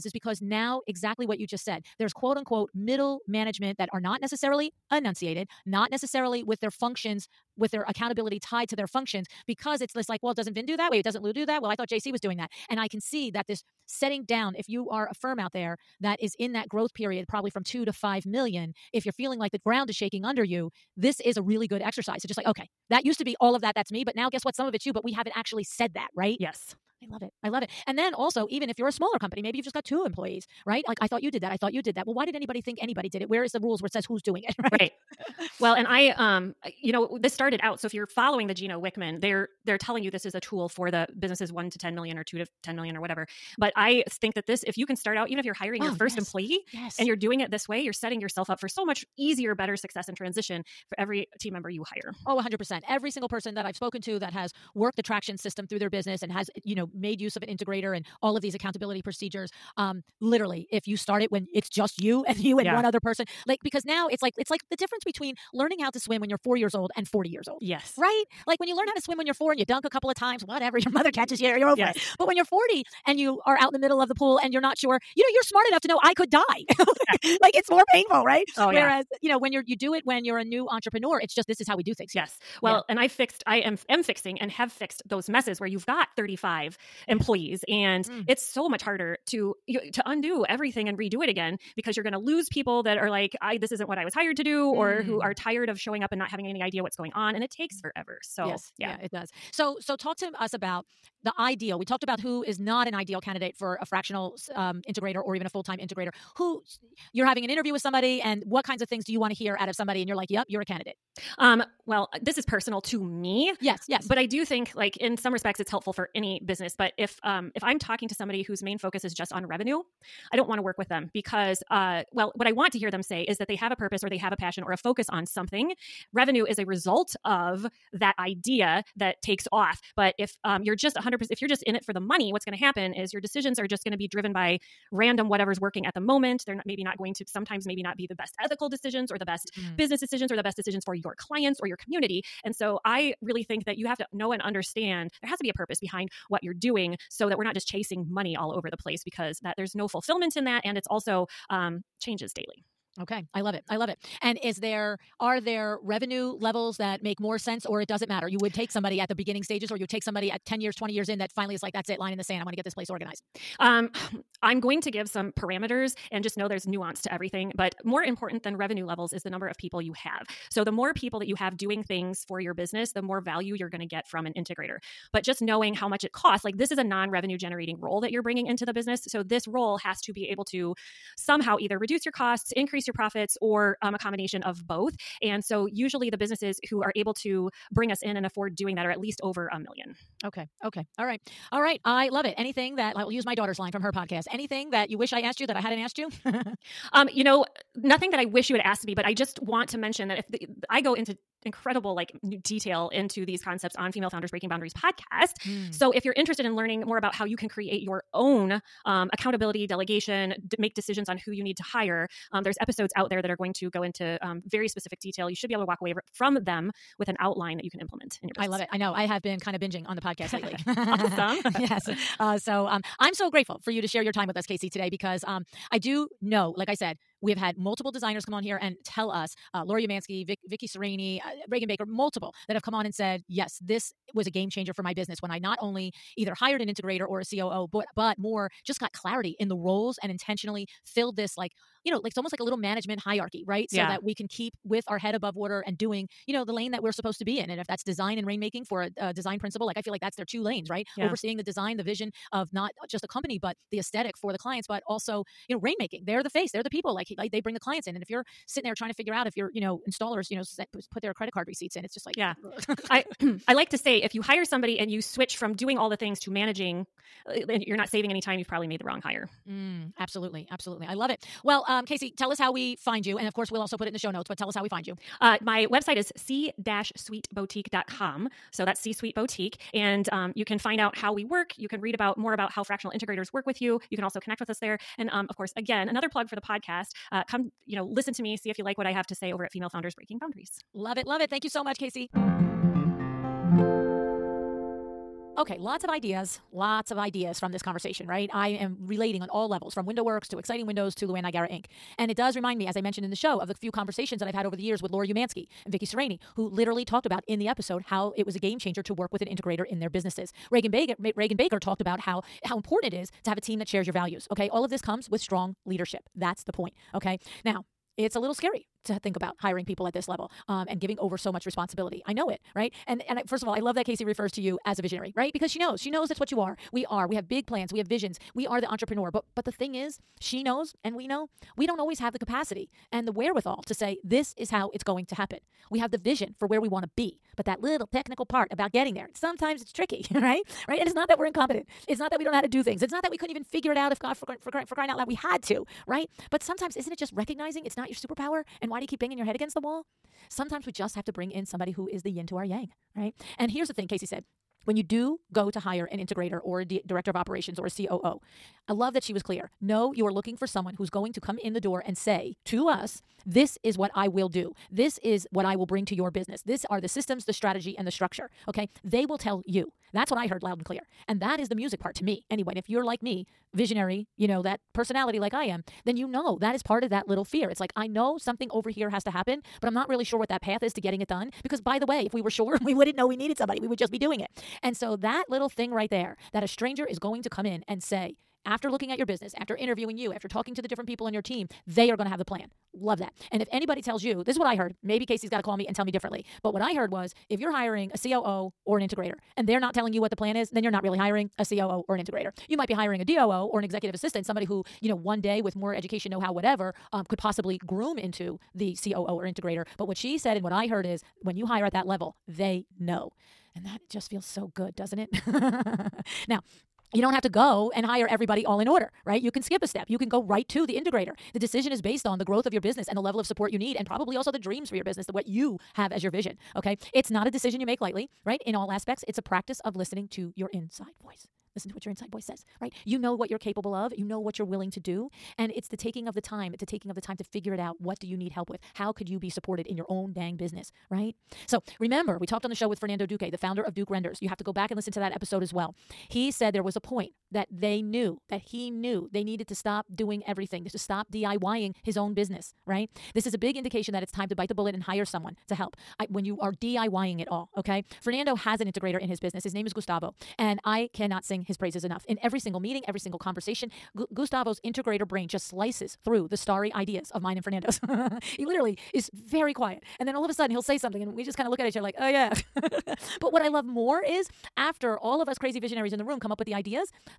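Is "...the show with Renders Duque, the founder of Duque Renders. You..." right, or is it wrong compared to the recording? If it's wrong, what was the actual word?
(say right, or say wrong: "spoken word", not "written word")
wrong: "Fernando", not "Renders".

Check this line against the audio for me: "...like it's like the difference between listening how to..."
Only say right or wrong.
wrong.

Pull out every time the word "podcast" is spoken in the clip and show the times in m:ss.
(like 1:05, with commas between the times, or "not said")
3:13, 3:24, 3:40, 4:46.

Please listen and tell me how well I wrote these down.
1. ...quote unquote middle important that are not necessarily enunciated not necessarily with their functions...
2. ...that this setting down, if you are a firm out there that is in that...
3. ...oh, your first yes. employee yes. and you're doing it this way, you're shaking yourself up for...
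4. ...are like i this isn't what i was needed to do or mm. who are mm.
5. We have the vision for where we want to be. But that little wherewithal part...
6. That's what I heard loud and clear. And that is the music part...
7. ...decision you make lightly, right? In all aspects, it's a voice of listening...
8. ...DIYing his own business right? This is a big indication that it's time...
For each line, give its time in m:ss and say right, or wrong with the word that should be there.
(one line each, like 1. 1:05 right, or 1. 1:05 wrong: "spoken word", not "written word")
1. 0:02 wrong: "management", not "important"
2. 0:13 right
3. 0:45 wrong: "setting", not "shaking"
4. 1:32 wrong: "hired", not "needed"
5. 5:35 wrong: "technical", not "wherewithal"
6. 6:09 right
7. 7:07 wrong: "practice", not "voice"
8. 7:31 right.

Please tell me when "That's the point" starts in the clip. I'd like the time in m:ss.
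5:16.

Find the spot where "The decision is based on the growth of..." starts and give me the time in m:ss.
7:01.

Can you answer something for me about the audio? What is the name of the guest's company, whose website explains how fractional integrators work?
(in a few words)
C Suite Boutique.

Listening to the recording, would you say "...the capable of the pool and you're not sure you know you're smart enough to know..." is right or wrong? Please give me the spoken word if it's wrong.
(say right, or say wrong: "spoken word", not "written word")
wrong: "middle", not "capable".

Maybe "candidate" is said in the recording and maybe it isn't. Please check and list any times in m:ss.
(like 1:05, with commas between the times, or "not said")
1:43, 1:50.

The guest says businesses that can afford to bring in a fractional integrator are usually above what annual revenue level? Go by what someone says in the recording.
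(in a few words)
over a million.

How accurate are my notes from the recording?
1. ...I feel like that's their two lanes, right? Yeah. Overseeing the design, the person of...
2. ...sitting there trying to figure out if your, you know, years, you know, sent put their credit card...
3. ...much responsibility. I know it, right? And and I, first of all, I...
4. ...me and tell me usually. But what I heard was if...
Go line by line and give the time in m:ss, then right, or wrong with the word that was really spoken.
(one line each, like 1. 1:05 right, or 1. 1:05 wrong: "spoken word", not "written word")
1. 4:09 wrong: "vision", not "person"
2. 4:18 wrong: "installers", not "years"
3. 5:21 right
4. 6:35 wrong: "differently", not "usually".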